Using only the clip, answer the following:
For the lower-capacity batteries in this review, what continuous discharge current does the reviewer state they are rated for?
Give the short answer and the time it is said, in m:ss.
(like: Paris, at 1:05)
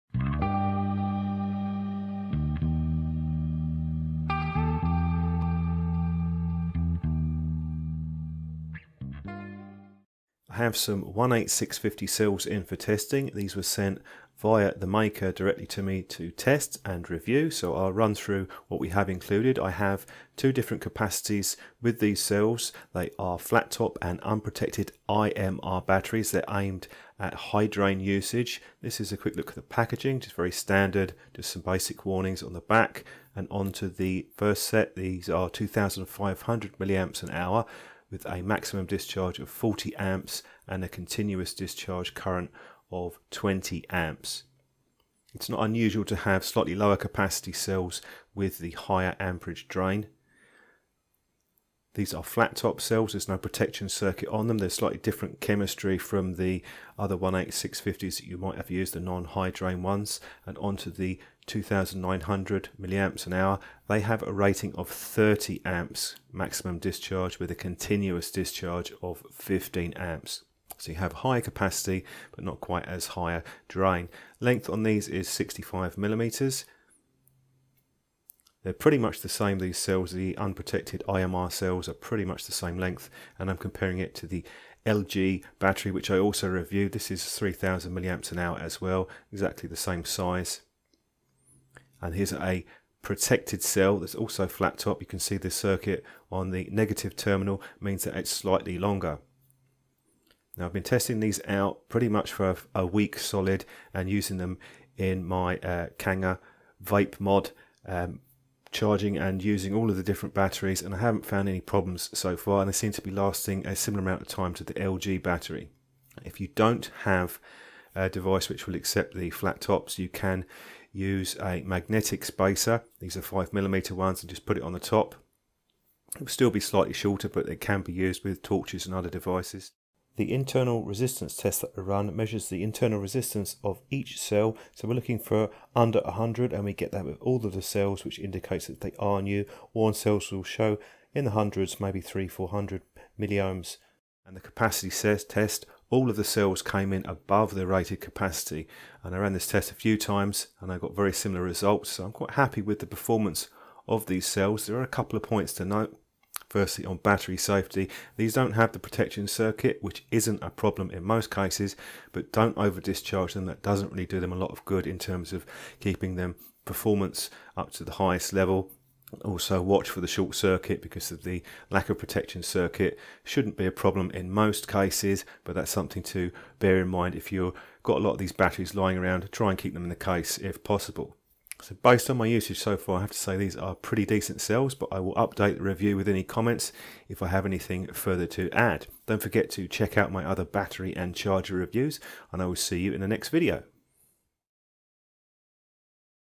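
20 amps, at 0:43.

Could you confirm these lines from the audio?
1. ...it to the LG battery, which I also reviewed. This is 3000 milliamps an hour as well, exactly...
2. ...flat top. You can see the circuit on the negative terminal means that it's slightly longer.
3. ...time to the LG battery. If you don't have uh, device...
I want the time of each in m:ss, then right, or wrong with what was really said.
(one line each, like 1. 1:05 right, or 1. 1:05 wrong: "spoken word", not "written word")
1. 1:23 right
2. 1:34 right
3. 1:54 right.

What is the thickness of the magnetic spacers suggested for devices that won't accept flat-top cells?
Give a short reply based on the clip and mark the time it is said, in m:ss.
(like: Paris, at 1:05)
5mm, at 2:03.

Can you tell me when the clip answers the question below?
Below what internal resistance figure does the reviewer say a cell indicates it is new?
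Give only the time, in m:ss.
2:16.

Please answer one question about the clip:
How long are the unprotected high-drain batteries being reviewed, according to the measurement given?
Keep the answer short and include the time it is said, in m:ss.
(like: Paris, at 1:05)
65 millimeters, at 1:15.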